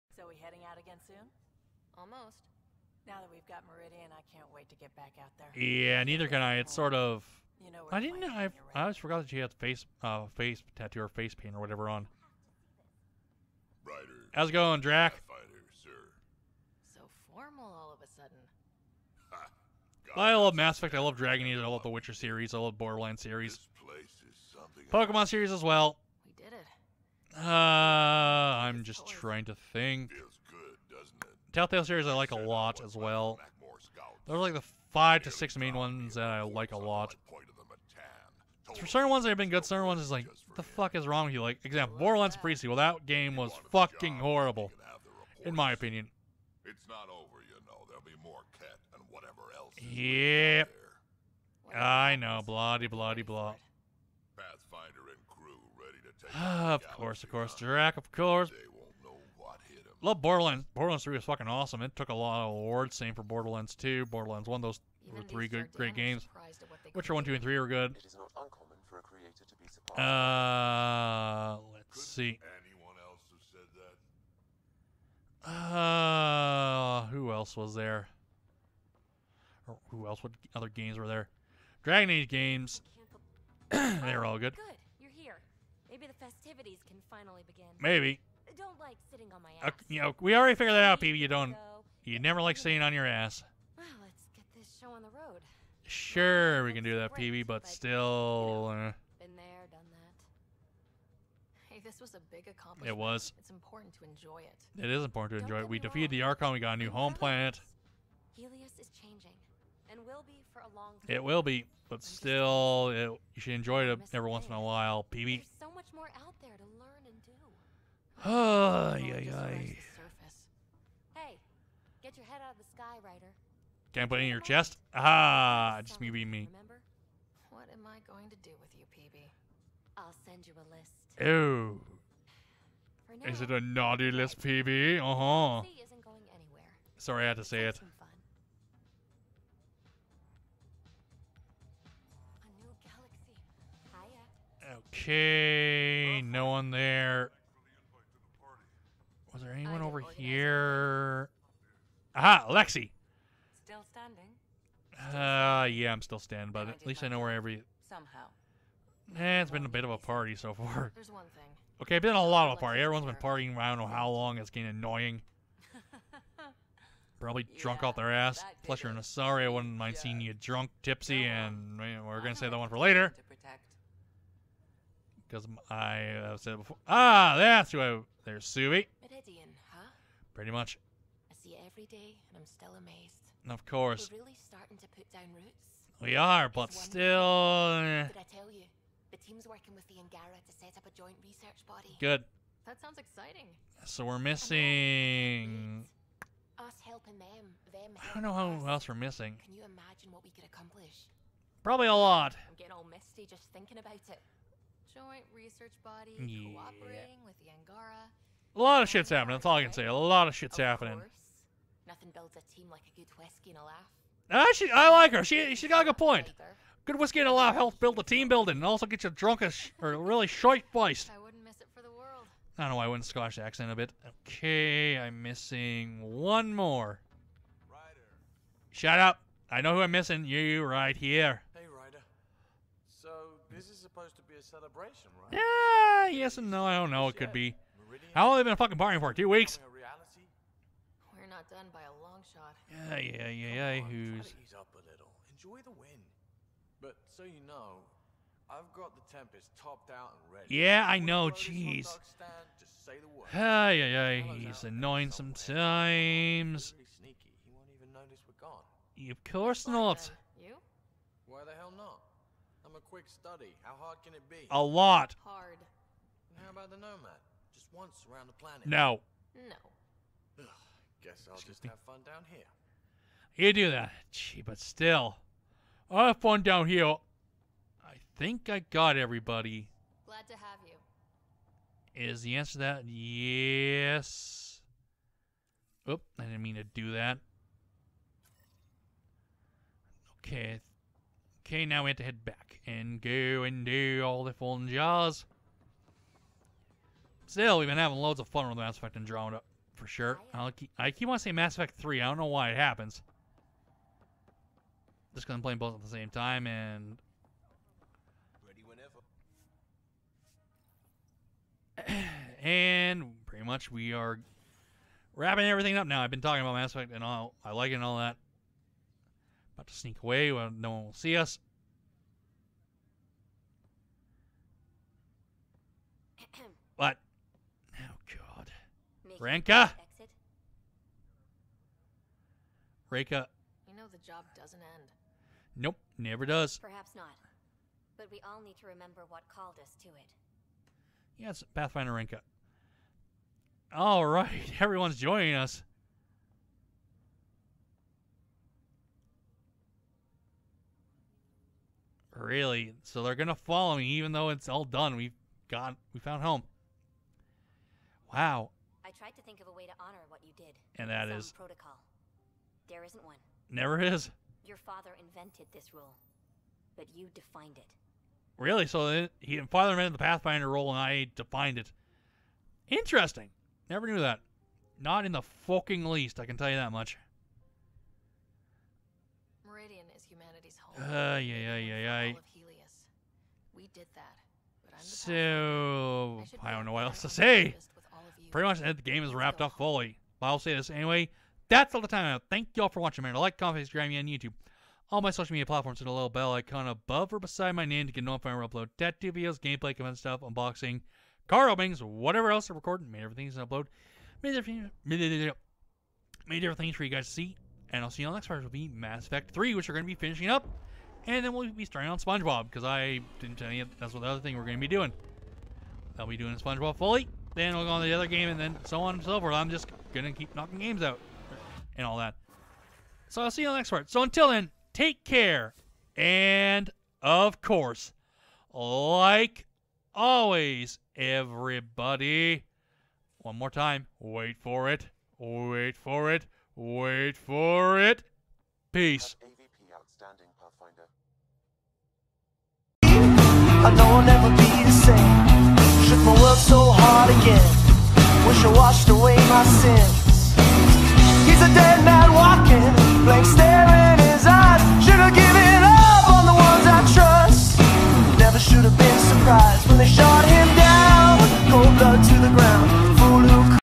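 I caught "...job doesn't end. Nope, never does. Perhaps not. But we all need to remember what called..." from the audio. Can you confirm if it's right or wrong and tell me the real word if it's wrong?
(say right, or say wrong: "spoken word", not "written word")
right.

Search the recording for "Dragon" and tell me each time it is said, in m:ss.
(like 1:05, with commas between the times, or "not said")
0:21, 1:21.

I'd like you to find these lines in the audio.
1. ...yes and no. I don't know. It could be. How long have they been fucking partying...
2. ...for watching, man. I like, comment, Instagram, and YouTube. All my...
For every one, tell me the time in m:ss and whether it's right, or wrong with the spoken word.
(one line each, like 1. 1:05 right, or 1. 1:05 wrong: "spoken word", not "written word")
1. 3:56 right
2. 6:32 right.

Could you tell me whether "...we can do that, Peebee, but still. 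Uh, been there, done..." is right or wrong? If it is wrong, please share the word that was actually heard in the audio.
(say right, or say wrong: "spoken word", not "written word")
right.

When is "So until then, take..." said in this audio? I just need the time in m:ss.
7:03.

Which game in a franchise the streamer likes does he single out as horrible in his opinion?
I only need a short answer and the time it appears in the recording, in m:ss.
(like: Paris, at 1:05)
Borderlands Pre-Sequel, at 0:41.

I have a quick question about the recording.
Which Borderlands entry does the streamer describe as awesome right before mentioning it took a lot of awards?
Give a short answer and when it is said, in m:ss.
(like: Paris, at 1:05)
Borderlands 3, at 1:00.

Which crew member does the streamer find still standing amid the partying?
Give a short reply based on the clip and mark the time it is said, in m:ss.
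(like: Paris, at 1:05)
Lexi, at 2:32.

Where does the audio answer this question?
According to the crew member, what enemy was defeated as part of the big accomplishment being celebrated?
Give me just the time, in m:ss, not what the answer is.
1:46.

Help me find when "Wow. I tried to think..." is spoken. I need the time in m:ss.
5:58.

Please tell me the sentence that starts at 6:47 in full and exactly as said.
And I'll see you on the next part, which will be Mass Effect 3, which we're going to be finishing up.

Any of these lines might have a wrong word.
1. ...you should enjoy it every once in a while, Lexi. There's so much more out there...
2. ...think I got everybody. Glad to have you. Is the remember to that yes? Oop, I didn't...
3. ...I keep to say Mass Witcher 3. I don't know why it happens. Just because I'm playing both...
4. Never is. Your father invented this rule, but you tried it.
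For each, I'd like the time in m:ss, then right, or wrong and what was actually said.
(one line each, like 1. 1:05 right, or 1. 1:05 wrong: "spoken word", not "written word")
1. 1:53 wrong: "Peebee", not "Lexi"
2. 4:38 wrong: "answer", not "remember"
3. 5:00 wrong: "Effect", not "Witcher"
4. 6:03 wrong: "defined", not "tried".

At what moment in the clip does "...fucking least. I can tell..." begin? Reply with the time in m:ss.
6:15.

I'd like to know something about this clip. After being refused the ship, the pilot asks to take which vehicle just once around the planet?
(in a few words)
The Nomad.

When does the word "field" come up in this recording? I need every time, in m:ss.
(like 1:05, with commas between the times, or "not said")
not said.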